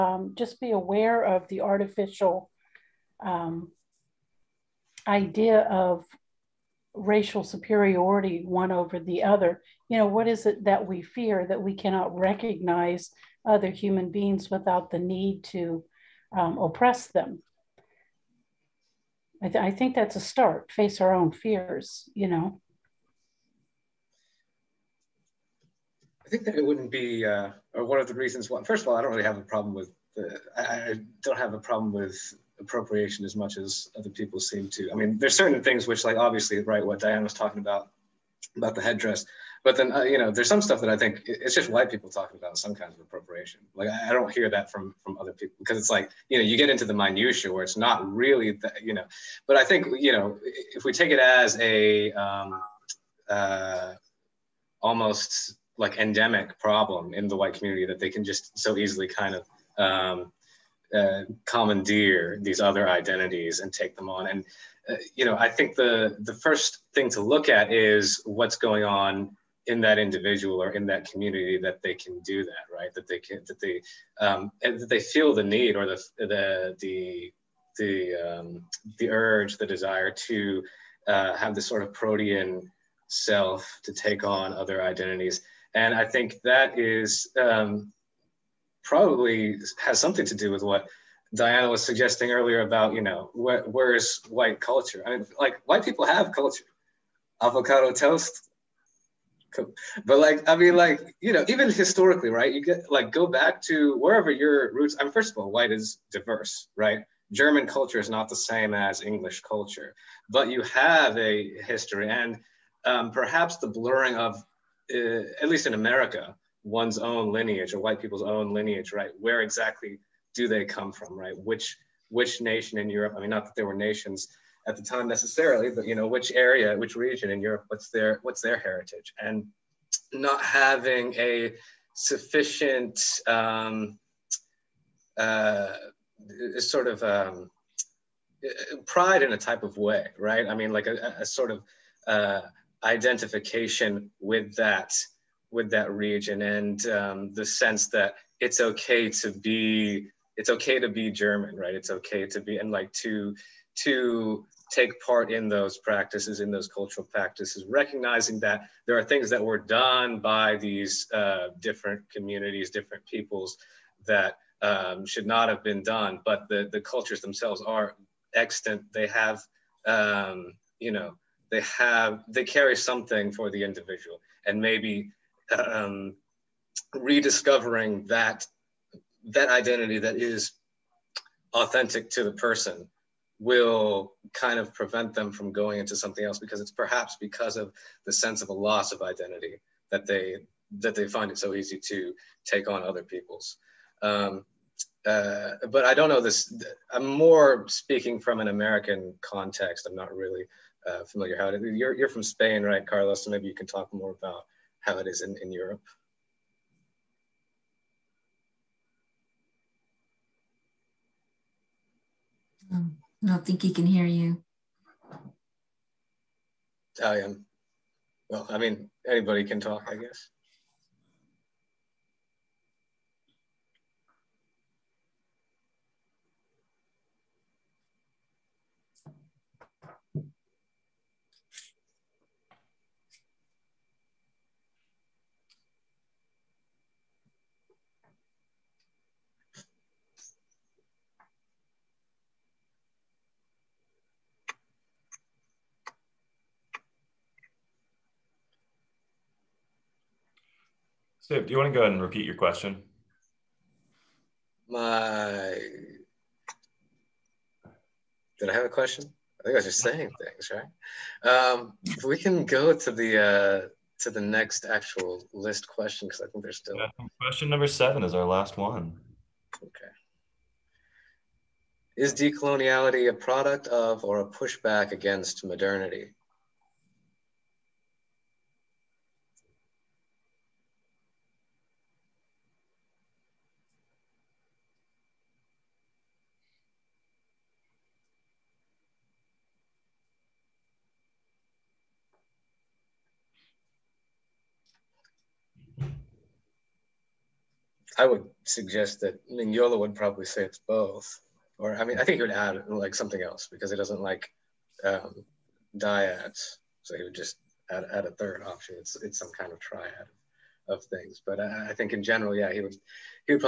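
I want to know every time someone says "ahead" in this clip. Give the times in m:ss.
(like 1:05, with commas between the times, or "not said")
4:11.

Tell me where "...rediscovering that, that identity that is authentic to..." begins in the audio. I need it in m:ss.
2:56.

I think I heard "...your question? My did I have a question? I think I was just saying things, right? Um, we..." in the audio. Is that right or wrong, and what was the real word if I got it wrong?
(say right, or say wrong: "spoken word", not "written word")
right.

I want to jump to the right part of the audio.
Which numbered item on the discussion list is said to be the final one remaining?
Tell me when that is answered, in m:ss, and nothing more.
4:27.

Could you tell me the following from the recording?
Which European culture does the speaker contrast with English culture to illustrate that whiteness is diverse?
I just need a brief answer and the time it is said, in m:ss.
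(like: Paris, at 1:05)
German culture, at 1:47.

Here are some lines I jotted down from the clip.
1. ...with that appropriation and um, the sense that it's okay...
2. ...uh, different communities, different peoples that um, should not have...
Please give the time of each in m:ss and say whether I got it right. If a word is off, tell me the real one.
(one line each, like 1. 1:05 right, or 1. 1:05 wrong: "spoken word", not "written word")
1. 2:25 wrong: "region", not "appropriation"
2. 2:41 right.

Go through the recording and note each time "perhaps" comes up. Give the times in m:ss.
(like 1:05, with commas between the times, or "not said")
1:53, 3:06.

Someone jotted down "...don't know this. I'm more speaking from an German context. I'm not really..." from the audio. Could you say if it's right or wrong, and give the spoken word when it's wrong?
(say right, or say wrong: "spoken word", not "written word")
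wrong: "American", not "German".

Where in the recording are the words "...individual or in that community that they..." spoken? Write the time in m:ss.
1:09.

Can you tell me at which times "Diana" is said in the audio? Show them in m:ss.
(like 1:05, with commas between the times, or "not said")
0:36, 1:31.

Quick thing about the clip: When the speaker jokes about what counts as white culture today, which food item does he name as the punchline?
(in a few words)
Avocado toast.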